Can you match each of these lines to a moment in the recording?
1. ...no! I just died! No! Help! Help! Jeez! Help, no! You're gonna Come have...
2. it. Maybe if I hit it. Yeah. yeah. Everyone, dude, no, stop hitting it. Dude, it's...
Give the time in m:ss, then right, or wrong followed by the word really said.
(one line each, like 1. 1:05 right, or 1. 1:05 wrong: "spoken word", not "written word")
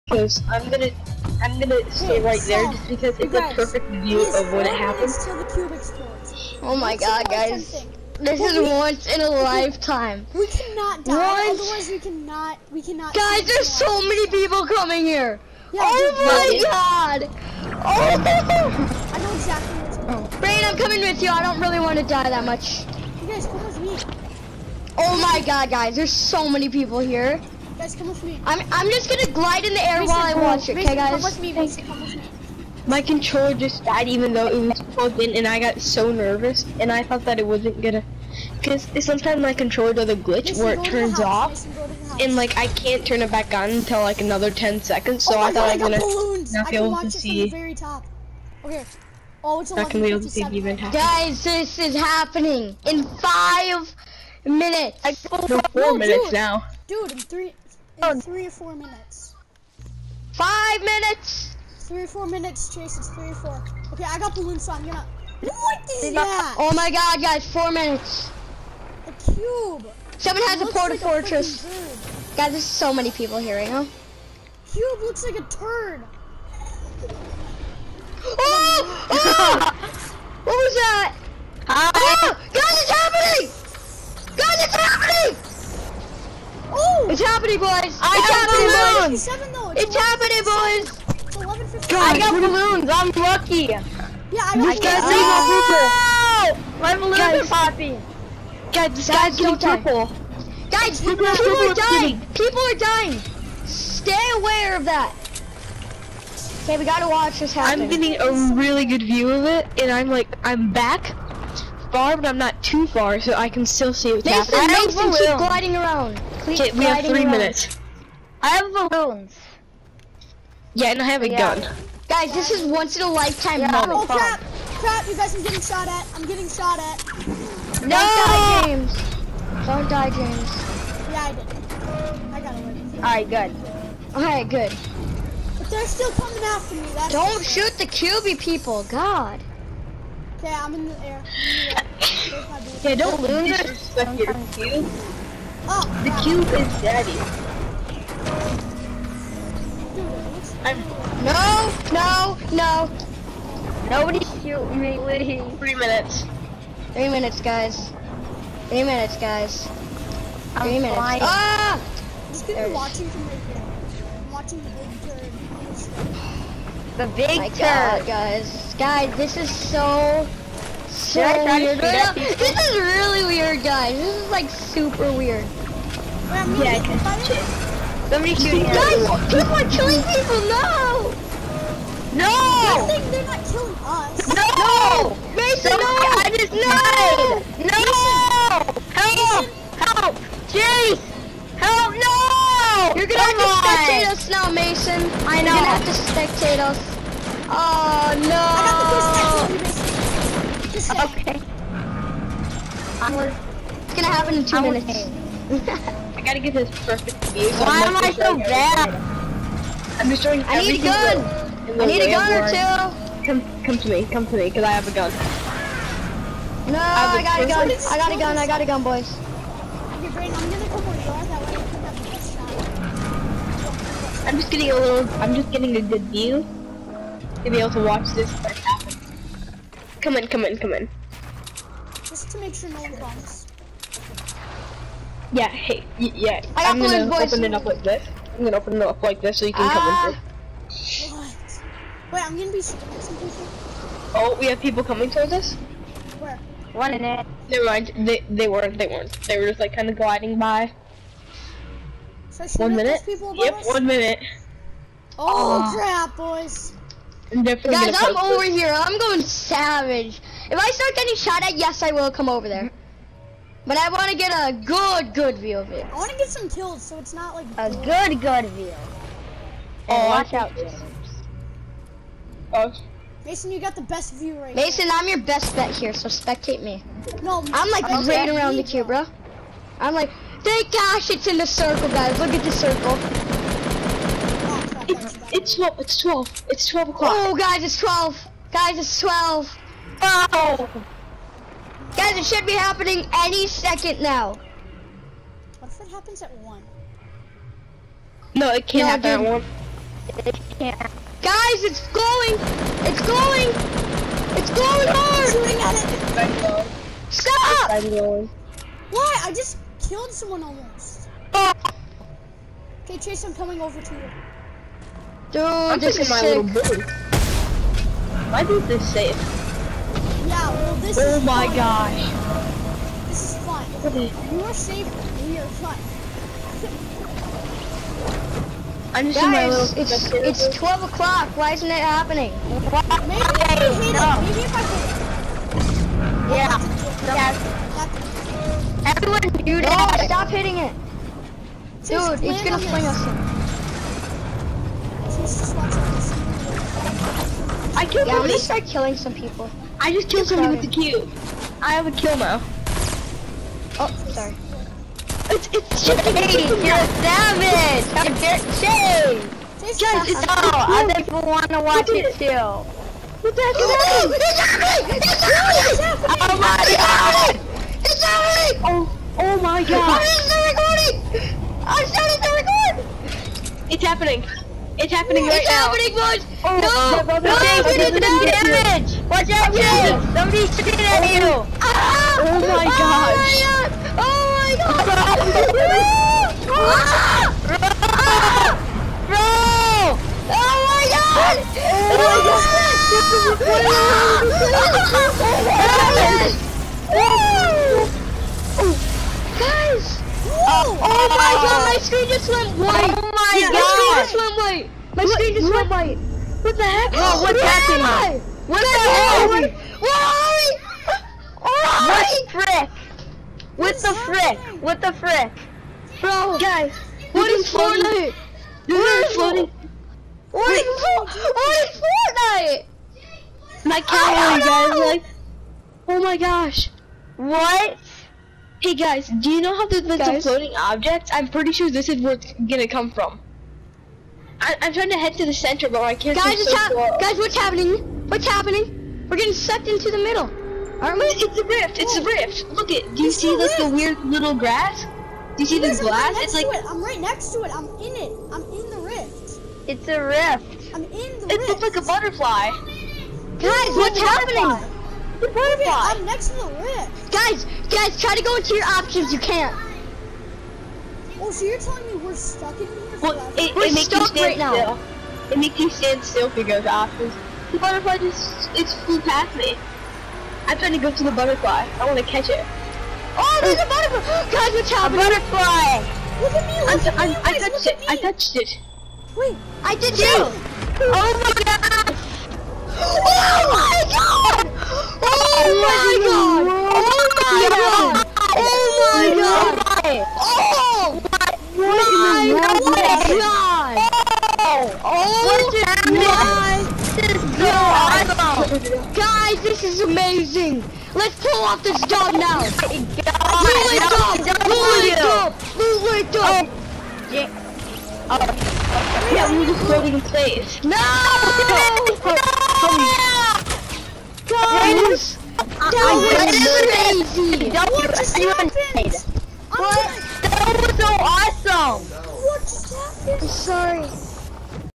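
1. 3:05 right
2. 5:34 right.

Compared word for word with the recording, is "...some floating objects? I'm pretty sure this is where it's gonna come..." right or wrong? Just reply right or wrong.
right.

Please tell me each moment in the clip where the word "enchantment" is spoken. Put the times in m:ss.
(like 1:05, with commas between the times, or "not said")
not said.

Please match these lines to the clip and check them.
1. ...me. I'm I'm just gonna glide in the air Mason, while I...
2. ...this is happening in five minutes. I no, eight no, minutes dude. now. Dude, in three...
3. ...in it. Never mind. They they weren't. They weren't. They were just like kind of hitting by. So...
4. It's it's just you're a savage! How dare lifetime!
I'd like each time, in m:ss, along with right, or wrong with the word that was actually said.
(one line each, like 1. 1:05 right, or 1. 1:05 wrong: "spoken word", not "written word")
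1. 0:28 right
2. 0:51 wrong: "four", not "eight"
3. 4:06 wrong: "gliding", not "hitting"
4. 5:55 wrong: "shame", not "lifetime".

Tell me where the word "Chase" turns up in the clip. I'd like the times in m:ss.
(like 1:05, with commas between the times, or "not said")
1:02, 5:12.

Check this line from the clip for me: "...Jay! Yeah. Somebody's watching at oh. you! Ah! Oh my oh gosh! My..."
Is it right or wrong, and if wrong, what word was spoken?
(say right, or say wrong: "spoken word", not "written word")
wrong: "shooting", not "watching".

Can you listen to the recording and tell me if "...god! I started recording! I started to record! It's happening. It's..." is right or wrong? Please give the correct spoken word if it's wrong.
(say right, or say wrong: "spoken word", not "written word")
right.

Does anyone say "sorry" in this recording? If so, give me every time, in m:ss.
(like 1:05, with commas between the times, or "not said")
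5:54, 8:43.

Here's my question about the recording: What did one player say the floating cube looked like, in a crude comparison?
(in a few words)
A turd.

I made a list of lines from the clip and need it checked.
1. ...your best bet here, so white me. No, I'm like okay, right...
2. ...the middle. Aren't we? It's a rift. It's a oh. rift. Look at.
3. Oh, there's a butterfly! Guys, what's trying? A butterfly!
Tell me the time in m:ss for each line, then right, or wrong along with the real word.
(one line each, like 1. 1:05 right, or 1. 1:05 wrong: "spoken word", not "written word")
1. 4:35 wrong: "spectate", not "white"
2. 7:19 right
3. 7:53 wrong: "happening", not "trying".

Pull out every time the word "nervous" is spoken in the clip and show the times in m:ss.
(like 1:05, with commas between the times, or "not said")
0:36.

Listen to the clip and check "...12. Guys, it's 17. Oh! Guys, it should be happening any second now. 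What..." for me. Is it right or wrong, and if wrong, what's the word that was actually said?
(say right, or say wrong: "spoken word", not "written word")
wrong: "12", not "17".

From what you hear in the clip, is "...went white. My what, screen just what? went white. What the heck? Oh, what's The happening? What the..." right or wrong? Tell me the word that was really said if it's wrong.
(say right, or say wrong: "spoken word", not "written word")
wrong: "Where", not "The".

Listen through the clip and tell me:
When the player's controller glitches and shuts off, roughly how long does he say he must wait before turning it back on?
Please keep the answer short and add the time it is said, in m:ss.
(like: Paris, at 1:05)
10 seconds, at 0:44.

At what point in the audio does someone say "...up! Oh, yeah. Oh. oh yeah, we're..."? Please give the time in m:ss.
8:26.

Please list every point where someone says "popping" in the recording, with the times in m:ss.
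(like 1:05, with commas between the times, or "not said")
1:37.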